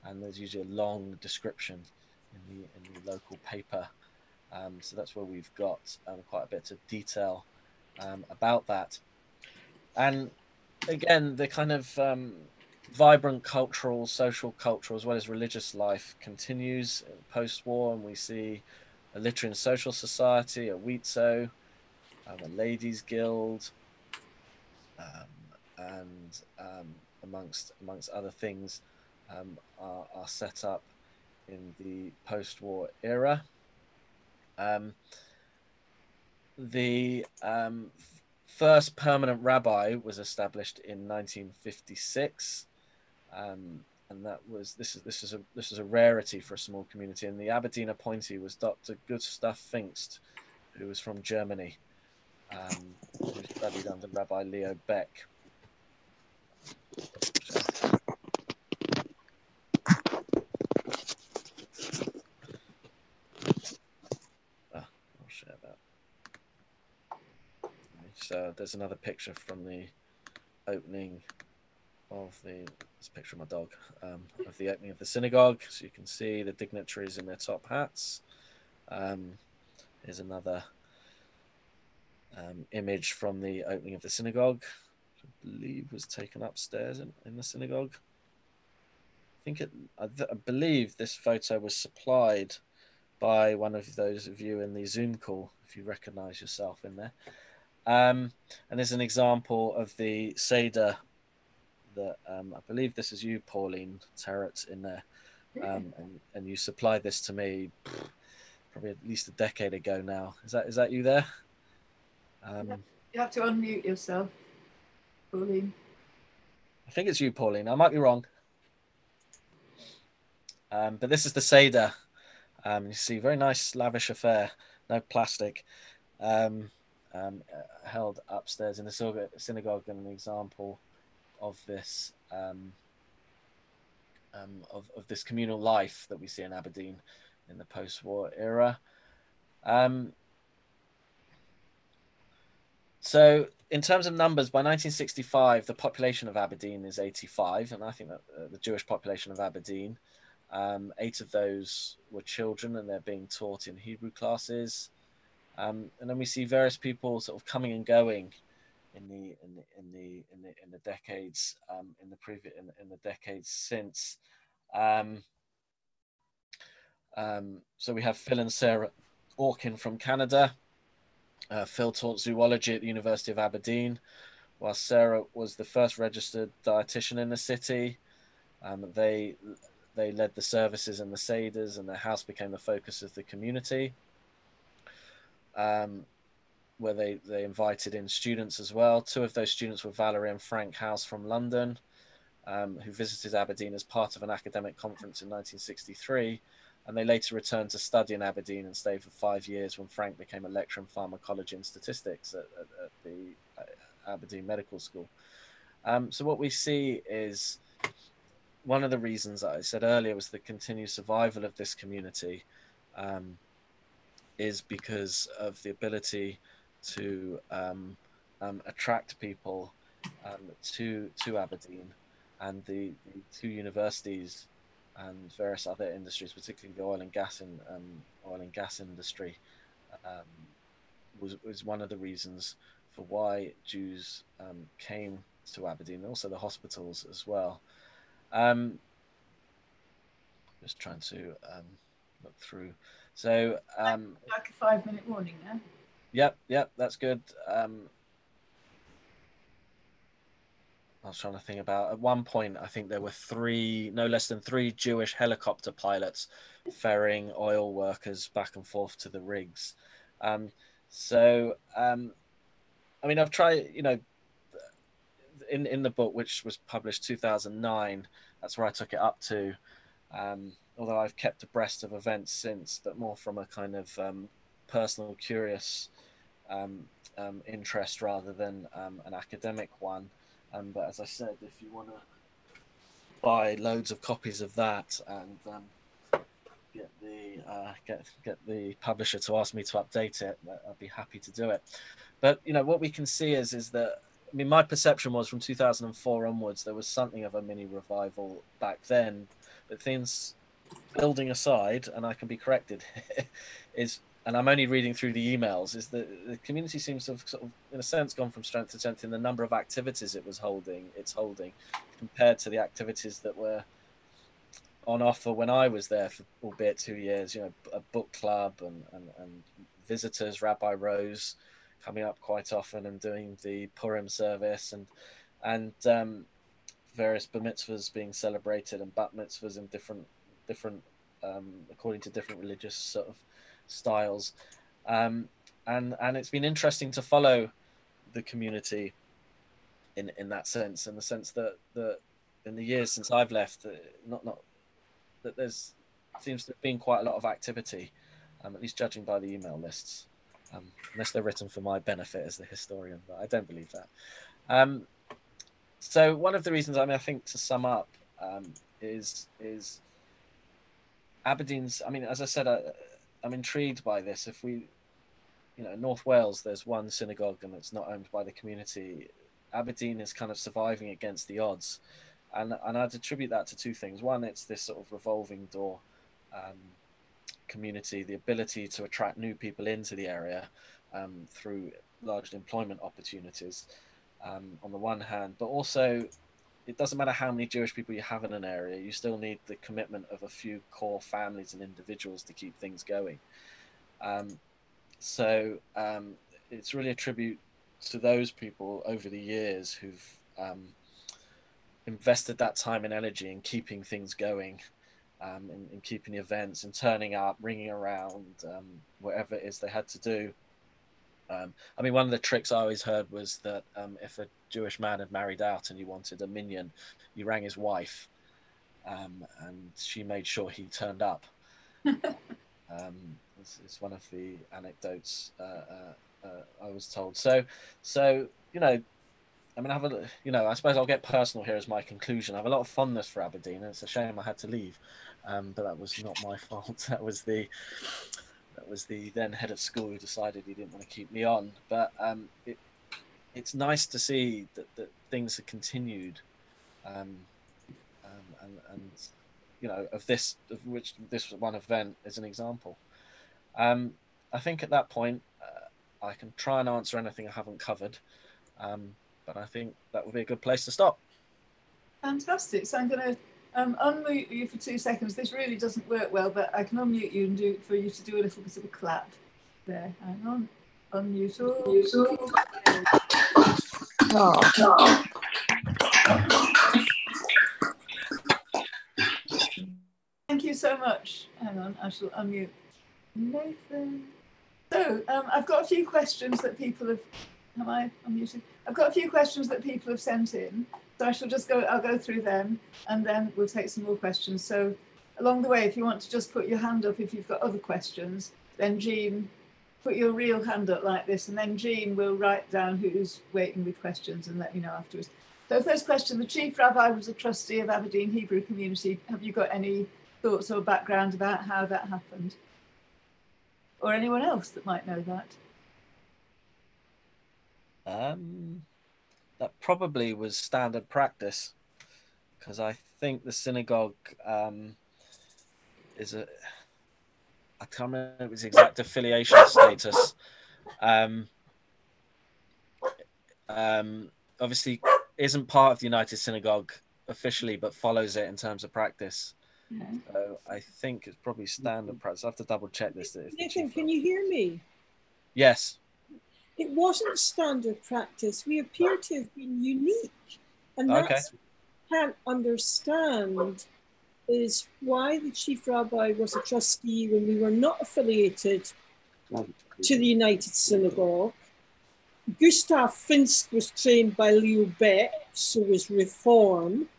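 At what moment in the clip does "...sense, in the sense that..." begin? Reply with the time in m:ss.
5:40.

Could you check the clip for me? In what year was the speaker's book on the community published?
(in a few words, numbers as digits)
2009.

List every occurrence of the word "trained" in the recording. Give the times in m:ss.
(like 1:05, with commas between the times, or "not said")
9:23.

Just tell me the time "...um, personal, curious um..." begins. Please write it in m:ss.
4:33.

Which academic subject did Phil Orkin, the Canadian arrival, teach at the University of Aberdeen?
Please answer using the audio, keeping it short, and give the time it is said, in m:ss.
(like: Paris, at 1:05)
Zoology, at 2:52.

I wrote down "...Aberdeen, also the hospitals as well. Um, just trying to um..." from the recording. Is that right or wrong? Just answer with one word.
right.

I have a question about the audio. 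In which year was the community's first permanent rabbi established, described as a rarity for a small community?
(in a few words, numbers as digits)
1956.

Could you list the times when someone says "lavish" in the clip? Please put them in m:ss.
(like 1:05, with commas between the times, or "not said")
2:03.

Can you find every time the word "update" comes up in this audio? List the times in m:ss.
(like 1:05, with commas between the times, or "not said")
4:49.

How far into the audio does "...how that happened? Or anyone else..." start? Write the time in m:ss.
8:31.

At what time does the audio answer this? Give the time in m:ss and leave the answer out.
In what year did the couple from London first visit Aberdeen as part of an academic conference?
3:15.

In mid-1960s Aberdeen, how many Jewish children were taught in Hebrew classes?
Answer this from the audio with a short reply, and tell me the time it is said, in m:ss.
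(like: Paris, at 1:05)
8, at 2:30.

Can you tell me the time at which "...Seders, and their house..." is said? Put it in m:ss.
3:01.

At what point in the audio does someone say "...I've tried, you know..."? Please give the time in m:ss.
4:23.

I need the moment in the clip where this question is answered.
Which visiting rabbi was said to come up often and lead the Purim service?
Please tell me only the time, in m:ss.
5:20.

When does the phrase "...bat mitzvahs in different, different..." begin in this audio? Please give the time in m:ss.
5:28.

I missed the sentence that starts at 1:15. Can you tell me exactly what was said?
So you can see the dignitaries in their top hats.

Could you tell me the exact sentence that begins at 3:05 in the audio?
Um, where they, they invited in students as well.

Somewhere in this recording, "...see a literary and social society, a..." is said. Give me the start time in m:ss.
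0:18.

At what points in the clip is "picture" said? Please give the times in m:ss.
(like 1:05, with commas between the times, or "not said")
1:08, 1:13.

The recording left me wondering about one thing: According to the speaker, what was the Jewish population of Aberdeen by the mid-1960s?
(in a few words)
85.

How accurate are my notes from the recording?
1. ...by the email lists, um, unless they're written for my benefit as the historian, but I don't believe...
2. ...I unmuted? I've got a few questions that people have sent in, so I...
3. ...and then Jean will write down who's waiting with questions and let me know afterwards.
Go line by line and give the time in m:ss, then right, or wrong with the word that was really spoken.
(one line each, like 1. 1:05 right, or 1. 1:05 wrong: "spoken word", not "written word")
1. 5:49 right
2. 8:07 right
3. 8:21 right.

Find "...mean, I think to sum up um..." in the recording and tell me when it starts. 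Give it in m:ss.
5:56.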